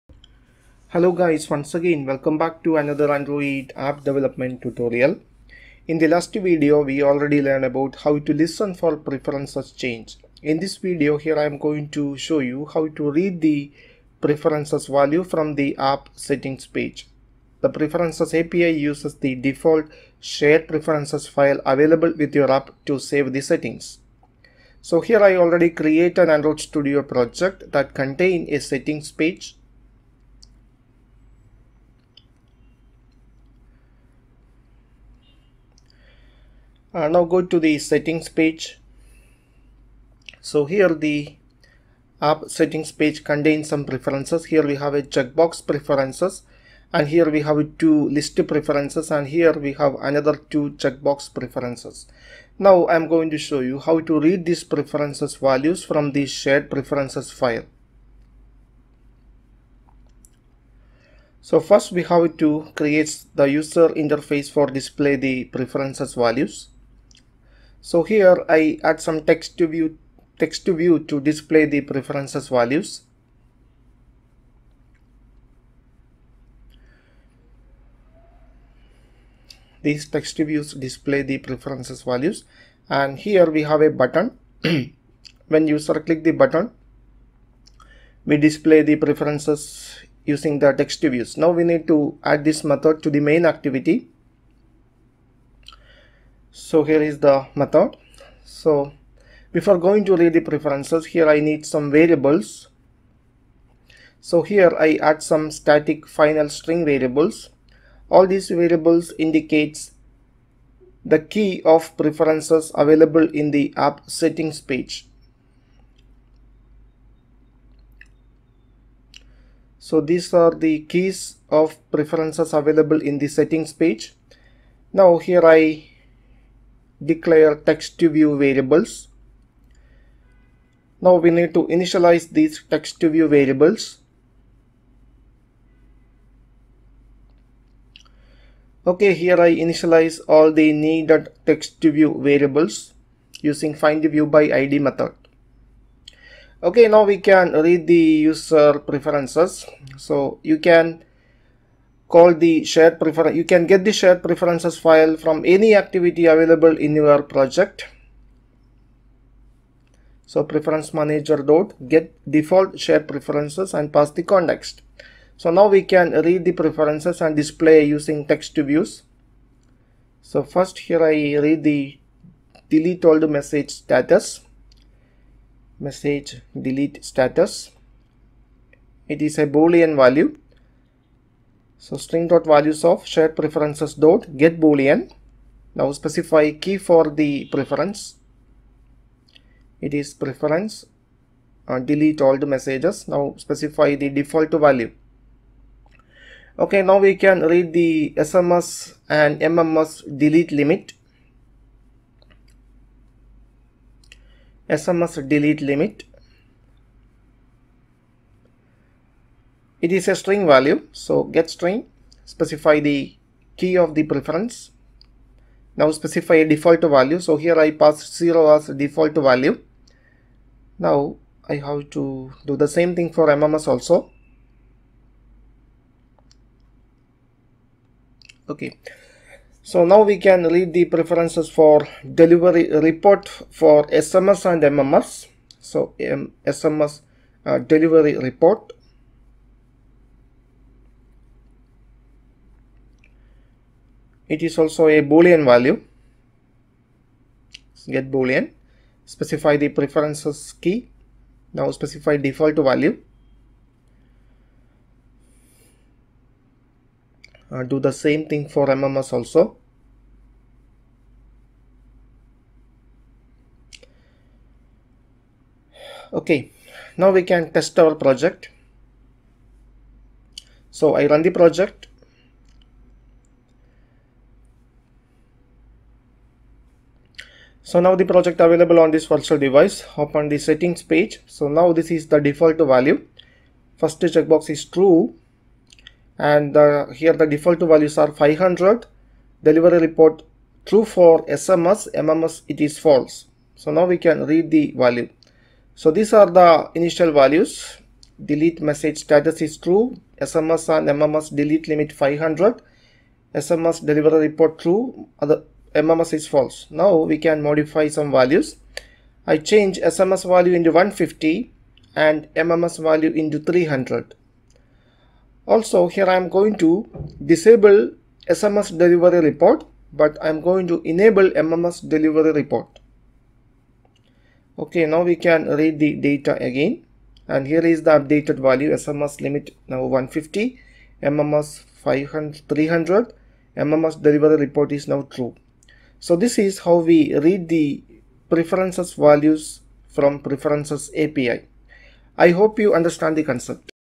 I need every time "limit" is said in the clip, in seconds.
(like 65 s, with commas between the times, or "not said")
200 s, 205 s, 301 s, 329 s.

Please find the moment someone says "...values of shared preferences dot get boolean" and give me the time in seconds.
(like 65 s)
182 s.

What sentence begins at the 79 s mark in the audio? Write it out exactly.
These text views display the preferences values and here we have a button.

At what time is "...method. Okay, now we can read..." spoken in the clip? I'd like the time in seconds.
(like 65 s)
144 s.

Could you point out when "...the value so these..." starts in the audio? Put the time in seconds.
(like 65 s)
294 s.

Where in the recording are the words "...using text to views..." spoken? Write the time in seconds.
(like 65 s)
167 s.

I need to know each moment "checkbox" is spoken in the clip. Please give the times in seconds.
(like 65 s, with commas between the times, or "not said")
45 s, 50 s, 284 s.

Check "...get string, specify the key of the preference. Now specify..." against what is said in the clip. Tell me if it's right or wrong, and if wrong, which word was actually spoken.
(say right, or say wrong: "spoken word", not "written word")
right.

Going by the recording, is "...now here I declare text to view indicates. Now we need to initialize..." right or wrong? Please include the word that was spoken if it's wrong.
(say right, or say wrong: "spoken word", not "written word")
wrong: "variables", not "indicates".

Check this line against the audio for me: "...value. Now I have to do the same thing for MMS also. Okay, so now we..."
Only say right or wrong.
right.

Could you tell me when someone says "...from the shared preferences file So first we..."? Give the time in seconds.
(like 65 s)
55 s.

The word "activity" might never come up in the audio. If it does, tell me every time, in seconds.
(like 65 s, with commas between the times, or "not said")
93 s, 155 s.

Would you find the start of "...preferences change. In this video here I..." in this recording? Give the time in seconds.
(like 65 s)
8 s.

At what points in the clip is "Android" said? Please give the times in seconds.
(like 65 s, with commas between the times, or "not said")
3 s, 26 s.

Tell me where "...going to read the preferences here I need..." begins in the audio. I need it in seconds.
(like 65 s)
99 s.